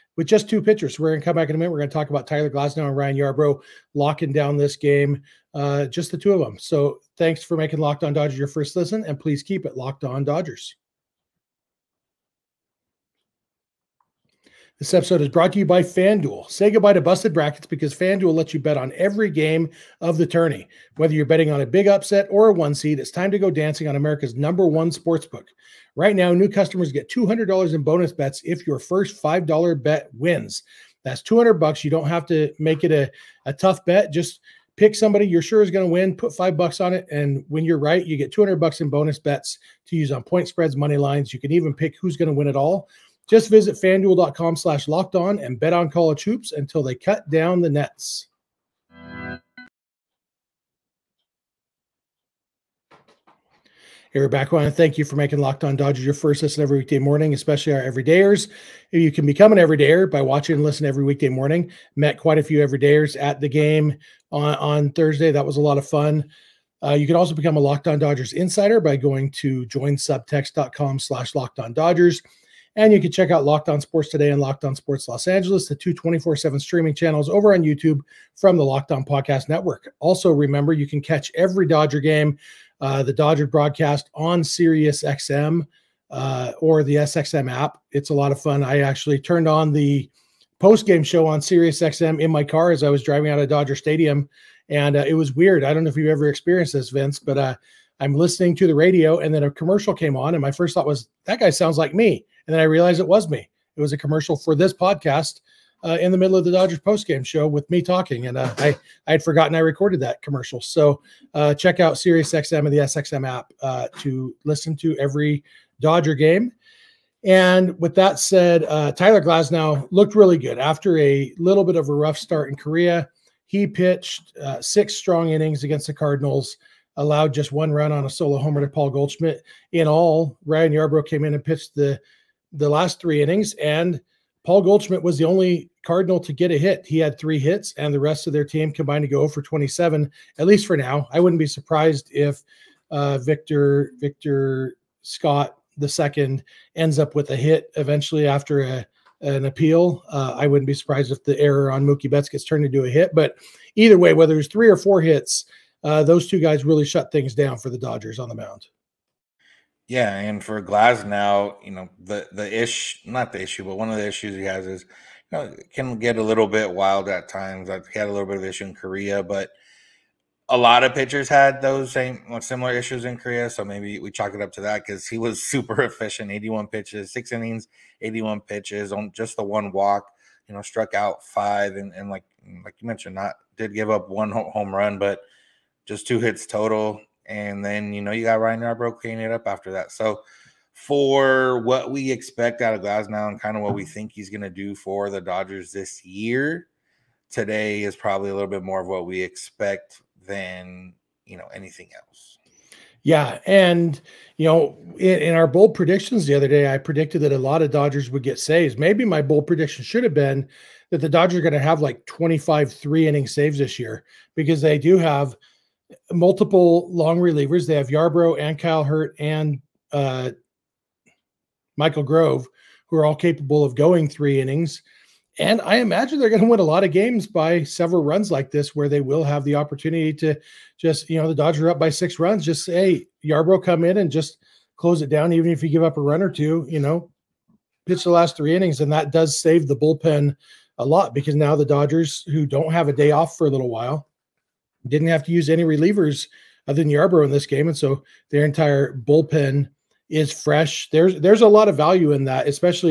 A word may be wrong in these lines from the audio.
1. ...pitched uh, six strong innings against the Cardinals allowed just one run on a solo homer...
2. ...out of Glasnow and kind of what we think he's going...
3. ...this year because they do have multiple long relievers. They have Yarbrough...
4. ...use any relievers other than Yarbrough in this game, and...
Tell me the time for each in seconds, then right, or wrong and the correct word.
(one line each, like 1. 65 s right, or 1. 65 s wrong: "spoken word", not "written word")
1. 123 s right
2. 192 s right
3. 213 s right
4. 245 s right.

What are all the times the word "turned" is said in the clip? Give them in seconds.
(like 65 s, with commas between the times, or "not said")
89 s, 152 s.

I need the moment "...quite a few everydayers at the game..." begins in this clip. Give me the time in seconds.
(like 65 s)
62 s.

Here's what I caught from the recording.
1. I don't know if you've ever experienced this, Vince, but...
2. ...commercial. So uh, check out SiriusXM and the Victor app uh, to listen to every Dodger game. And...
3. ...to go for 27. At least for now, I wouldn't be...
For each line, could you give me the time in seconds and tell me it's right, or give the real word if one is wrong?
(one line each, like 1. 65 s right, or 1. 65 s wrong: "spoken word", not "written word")
1. 95 s right
2. 110 s wrong: "SXM", not "Victor"
3. 139 s right.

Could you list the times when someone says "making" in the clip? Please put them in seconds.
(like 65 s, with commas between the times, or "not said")
7 s, 55 s.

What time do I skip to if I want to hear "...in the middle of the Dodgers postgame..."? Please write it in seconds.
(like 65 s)
106 s.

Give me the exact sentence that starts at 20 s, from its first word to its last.
Whether you're betting on a big upset or a one seed, it's time to go dancing on America's number one sportsbook.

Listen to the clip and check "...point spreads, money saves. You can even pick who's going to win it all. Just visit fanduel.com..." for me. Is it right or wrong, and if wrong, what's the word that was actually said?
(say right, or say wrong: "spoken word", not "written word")
wrong: "lines", not "saves".